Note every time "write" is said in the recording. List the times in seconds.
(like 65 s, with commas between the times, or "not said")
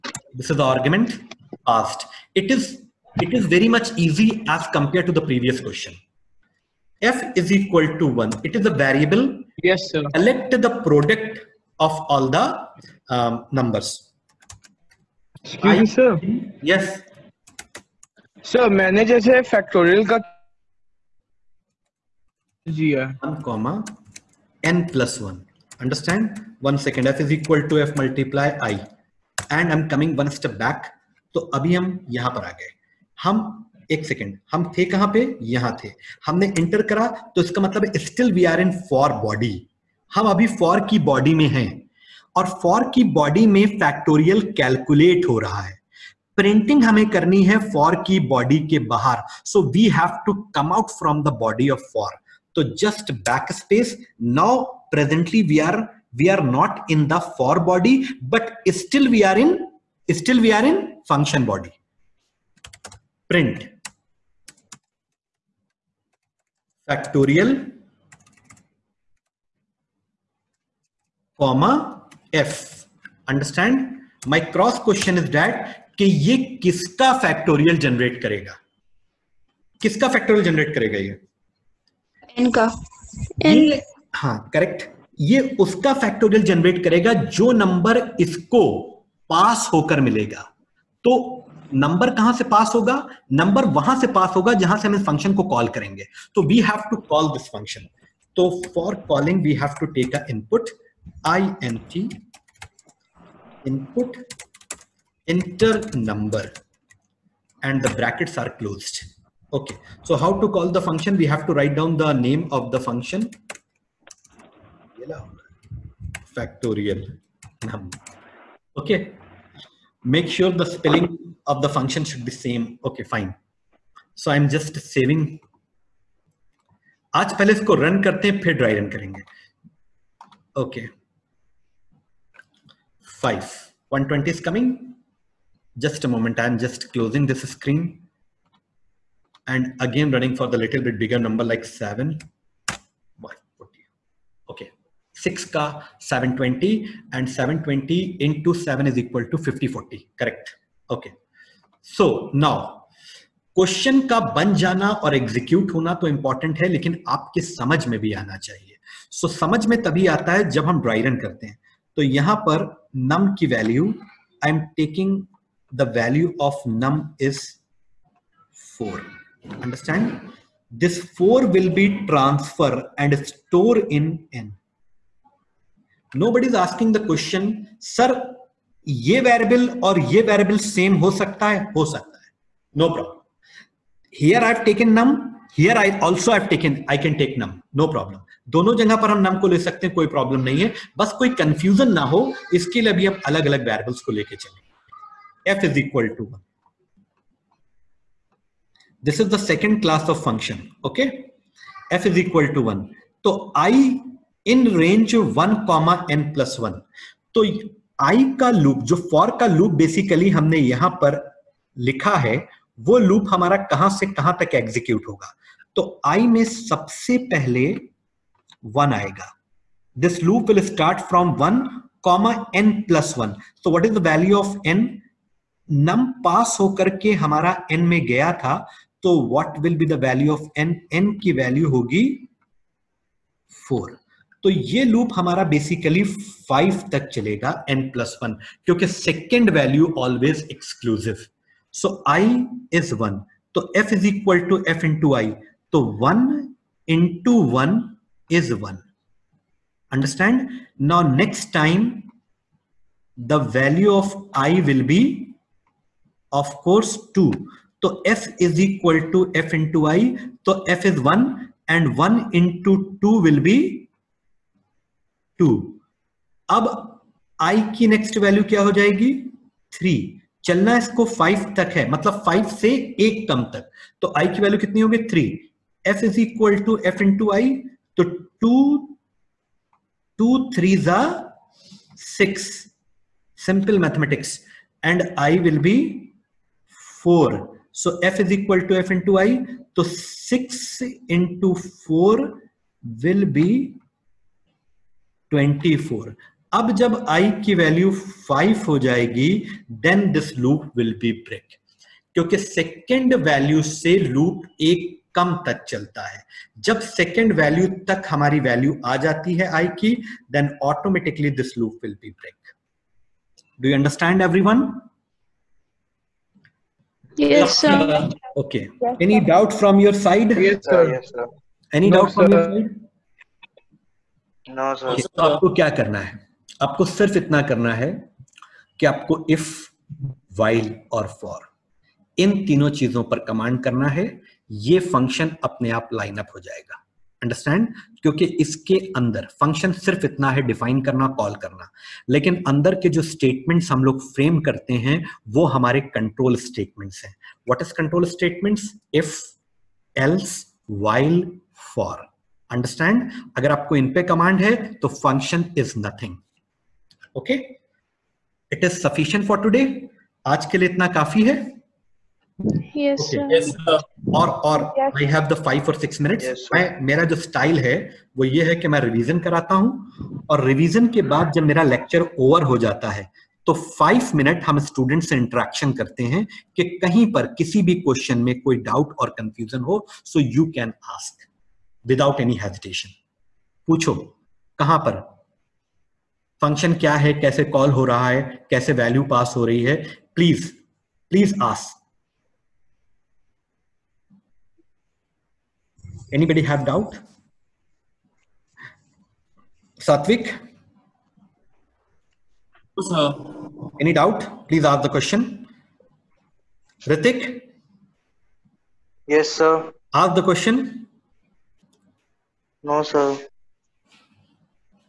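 111 s.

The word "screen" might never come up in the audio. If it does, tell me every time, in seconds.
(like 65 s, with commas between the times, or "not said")
137 s.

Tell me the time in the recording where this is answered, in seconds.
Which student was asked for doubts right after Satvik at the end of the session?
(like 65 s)
406 s.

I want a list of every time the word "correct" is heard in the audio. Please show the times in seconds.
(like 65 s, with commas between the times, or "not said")
150 s.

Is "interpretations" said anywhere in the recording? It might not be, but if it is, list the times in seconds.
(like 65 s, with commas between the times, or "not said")
not said.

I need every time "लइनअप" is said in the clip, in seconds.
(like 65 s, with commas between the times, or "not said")
335 s.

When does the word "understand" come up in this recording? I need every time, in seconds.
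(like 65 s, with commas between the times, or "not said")
25 s, 169 s.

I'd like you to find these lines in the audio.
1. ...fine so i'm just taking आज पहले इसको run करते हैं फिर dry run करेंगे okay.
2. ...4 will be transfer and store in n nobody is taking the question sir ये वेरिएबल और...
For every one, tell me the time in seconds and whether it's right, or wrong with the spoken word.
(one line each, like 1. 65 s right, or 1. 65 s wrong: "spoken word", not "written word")
1. 123 s wrong: "saving", not "taking"
2. 171 s wrong: "asking", not "taking".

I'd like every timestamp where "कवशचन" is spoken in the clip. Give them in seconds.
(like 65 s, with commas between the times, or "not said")
74 s, 153 s, 377 s.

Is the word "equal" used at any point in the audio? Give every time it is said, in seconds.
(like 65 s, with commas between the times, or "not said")
7 s, 27 s, 149 s.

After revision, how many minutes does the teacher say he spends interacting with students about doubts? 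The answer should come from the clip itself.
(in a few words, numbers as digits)
5.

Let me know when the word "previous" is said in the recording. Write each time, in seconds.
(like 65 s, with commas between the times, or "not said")
5 s.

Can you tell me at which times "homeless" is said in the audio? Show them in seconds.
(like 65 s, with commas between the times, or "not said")
not said.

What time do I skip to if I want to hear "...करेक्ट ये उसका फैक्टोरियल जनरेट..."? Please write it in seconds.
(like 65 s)
84 s.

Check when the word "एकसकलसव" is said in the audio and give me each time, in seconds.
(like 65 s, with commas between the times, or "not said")
240 s.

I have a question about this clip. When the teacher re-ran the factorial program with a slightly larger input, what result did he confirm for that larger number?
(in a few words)
5040.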